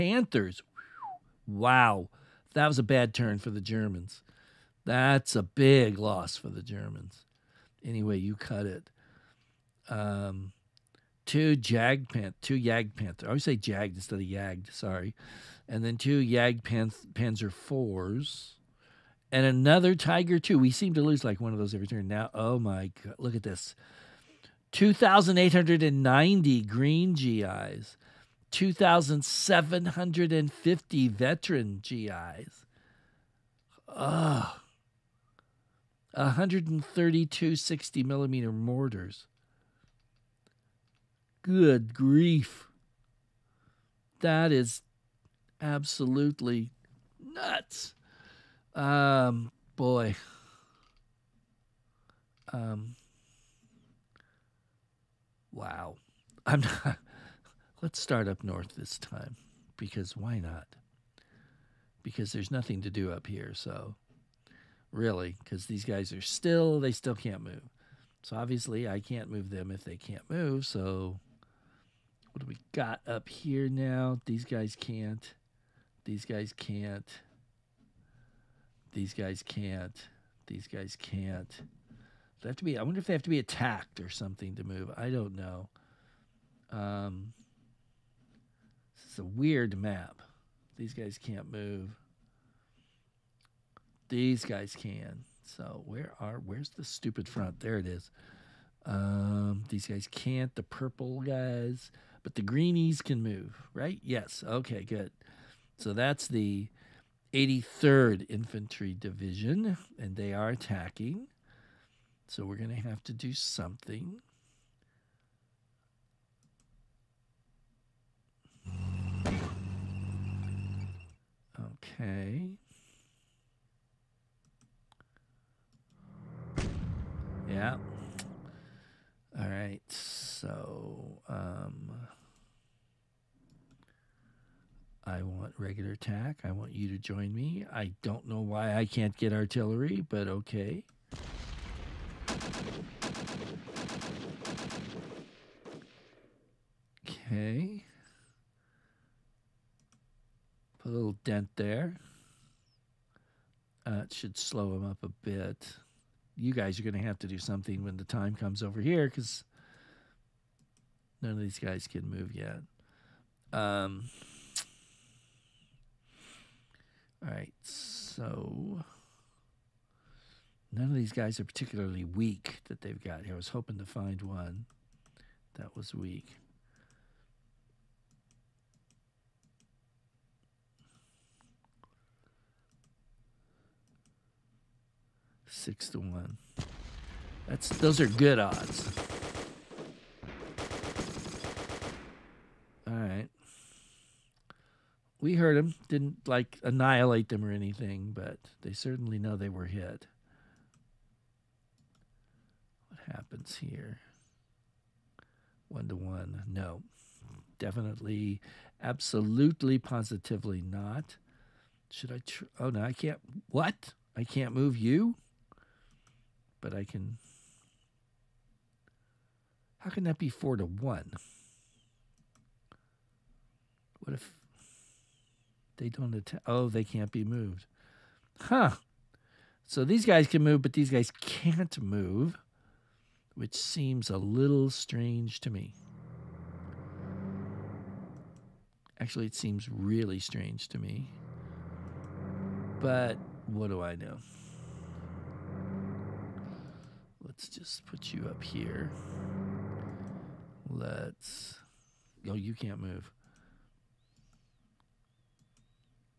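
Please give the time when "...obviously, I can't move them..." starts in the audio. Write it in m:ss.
1:08.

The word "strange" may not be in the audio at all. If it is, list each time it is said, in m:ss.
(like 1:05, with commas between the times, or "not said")
3:54, 4:00.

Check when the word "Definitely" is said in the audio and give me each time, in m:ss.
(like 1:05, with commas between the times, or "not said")
3:27.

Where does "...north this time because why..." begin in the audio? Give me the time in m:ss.
0:58.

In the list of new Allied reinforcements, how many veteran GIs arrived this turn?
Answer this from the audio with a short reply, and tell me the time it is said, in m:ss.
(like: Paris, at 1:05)
2,750, at 0:28.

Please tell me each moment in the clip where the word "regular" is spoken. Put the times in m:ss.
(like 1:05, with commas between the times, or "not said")
2:15.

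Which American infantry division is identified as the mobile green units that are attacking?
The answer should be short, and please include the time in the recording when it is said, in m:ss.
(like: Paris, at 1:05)
83rd Infantry Division, at 1:47.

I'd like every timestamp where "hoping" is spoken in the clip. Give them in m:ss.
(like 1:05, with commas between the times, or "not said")
2:53.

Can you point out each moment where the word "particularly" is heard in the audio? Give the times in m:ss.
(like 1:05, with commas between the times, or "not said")
2:51.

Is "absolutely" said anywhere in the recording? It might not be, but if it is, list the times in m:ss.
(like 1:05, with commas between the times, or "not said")
0:45, 3:28.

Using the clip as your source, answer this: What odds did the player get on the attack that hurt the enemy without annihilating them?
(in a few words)
6 to 1.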